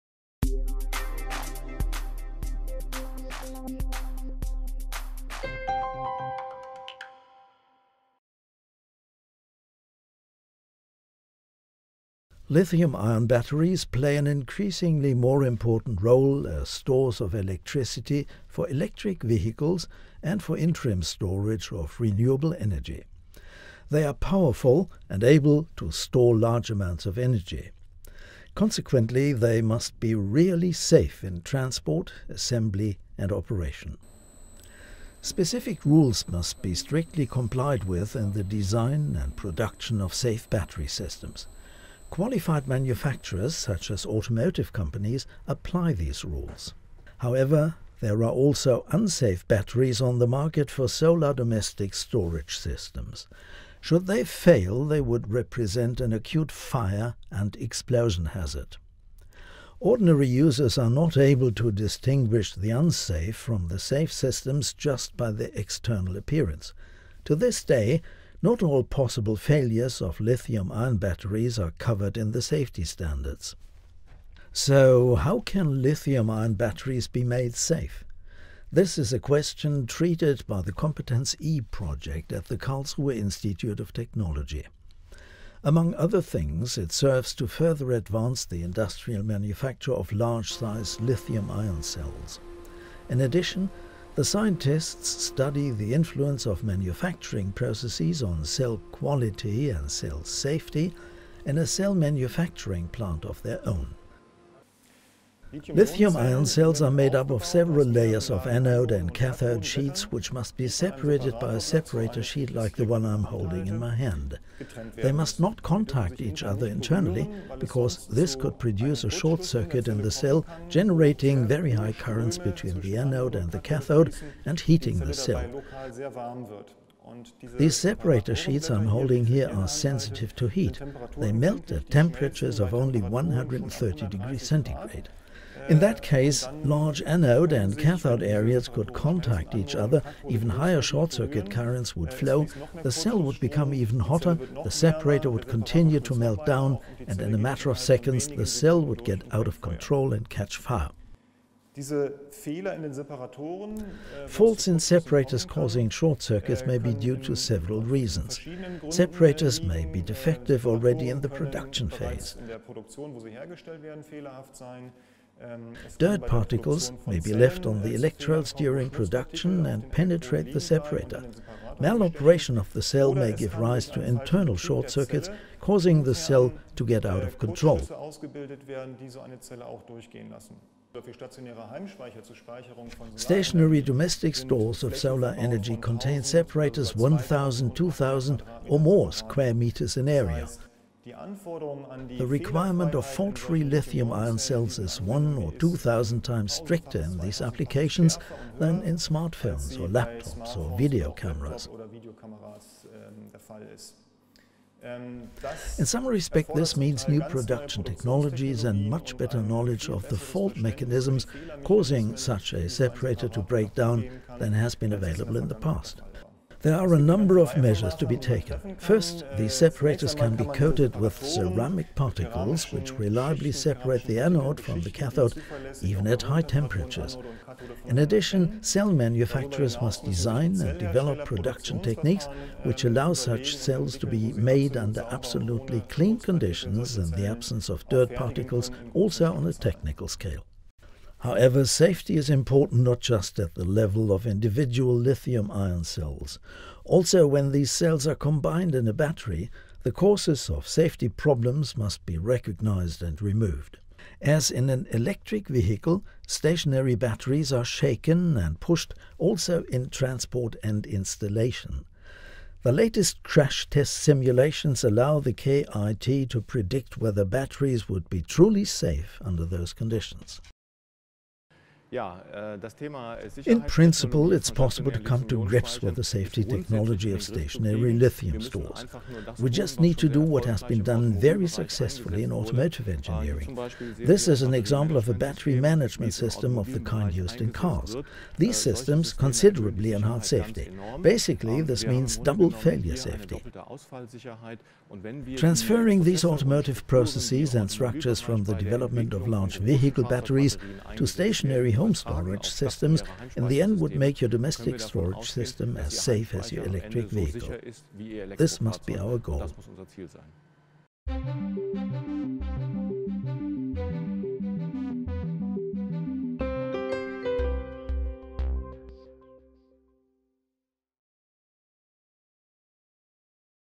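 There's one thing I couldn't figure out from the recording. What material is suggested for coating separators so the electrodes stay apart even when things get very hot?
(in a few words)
ceramic particles.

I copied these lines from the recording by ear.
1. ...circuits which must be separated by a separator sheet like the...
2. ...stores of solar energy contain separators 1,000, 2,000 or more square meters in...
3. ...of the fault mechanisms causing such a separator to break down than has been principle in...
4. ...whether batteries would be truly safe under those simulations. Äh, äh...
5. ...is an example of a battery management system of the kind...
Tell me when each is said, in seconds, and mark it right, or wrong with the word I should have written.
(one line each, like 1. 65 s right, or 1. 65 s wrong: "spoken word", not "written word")
1. 109 s wrong: "sheets", not "circuits"
2. 184 s right
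3. 209 s wrong: "available", not "principle"
4. 266 s wrong: "conditions", not "simulations"
5. 284 s right.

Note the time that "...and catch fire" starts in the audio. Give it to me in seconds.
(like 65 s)
150 s.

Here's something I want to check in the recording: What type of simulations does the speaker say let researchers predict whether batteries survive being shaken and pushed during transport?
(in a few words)
crash test simulations.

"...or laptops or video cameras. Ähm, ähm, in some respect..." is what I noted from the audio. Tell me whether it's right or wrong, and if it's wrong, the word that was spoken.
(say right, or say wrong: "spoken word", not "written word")
right.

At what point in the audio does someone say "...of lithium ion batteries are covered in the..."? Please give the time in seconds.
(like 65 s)
70 s.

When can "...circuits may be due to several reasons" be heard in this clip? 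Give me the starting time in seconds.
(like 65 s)
156 s.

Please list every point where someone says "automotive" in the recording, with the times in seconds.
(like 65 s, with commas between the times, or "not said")
44 s, 282 s, 296 s.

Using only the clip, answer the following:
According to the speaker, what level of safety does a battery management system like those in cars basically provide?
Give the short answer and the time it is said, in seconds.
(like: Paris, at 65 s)
double failure safety, at 292 s.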